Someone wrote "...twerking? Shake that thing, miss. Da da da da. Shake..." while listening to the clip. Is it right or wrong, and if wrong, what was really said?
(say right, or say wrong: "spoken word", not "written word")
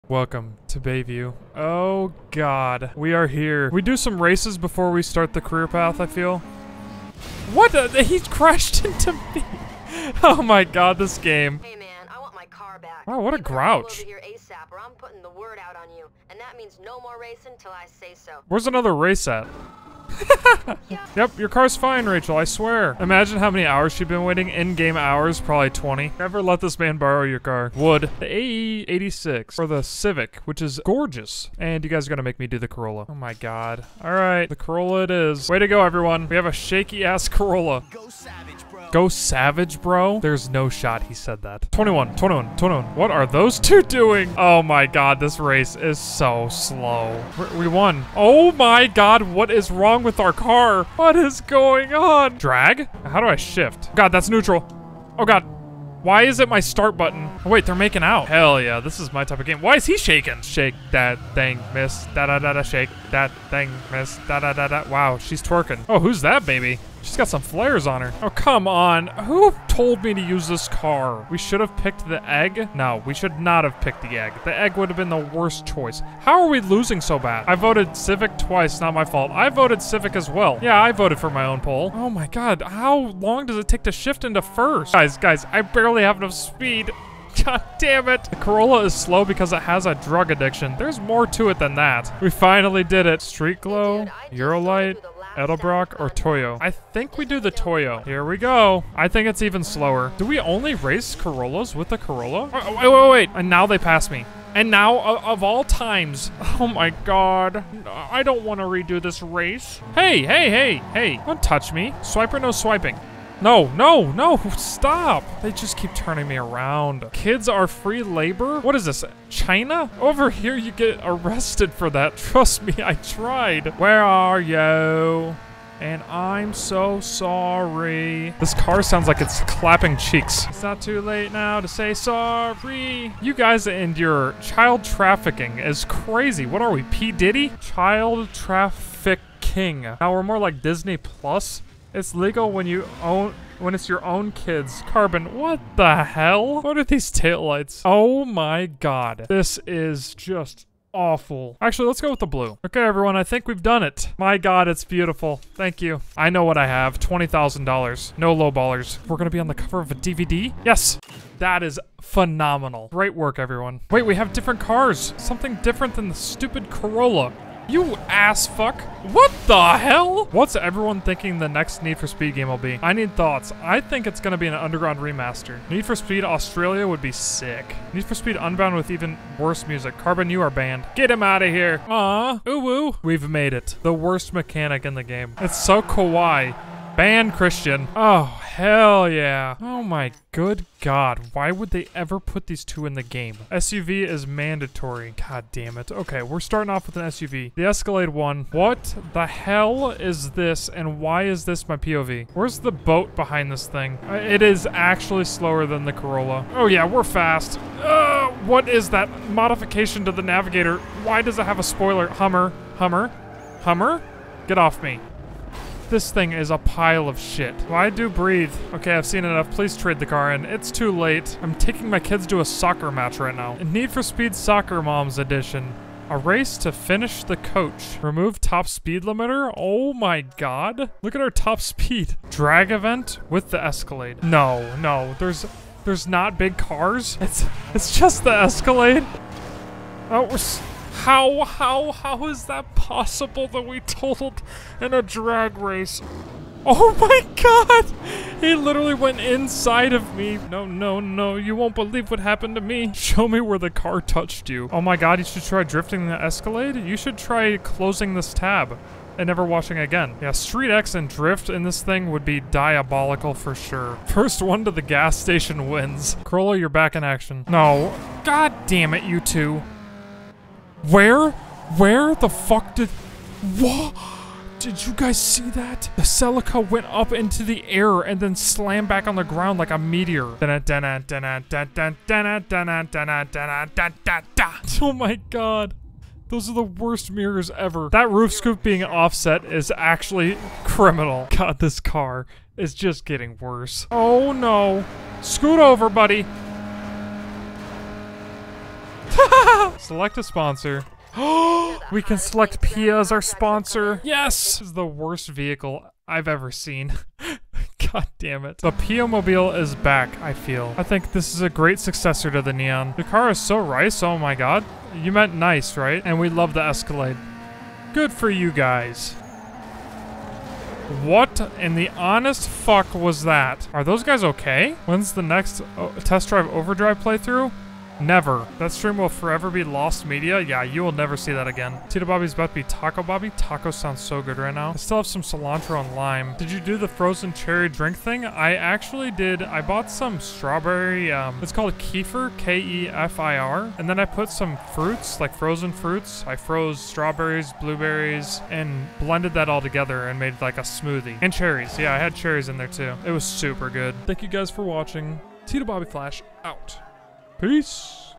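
wrong: "shaking", not "twerking".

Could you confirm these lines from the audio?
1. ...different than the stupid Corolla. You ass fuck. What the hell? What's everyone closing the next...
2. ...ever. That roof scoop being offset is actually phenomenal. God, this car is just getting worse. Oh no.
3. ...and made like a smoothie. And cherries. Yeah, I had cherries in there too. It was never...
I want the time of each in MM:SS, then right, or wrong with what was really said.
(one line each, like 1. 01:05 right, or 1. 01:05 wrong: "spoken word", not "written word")
1. 02:45 wrong: "thinking", not "closing"
2. 04:47 wrong: "criminal", not "phenomenal"
3. 05:50 wrong: "super", not "never".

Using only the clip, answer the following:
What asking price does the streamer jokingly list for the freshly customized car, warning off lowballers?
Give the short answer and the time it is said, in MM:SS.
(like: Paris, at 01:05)
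$20,000, at 02:36.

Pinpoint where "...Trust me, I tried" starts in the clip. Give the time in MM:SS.
02:02.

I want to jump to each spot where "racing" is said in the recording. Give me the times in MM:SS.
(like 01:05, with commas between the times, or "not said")
00:17.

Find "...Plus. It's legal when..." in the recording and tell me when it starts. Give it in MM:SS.
02:20.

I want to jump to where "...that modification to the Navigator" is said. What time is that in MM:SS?
03:28.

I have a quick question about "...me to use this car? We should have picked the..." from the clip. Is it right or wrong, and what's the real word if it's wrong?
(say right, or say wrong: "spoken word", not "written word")
right.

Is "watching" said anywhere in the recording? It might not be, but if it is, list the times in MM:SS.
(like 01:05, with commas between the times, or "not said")
04:19, 05:54.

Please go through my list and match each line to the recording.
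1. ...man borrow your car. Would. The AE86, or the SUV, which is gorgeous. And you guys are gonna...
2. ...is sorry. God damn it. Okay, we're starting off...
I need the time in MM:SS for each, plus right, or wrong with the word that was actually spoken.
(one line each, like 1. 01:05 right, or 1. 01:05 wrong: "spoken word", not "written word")
1. 00:26 wrong: "Civic", not "SUV"
2. 03:14 wrong: "mandatory", not "sorry".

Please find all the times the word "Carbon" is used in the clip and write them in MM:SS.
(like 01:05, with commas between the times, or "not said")
02:24, 02:59.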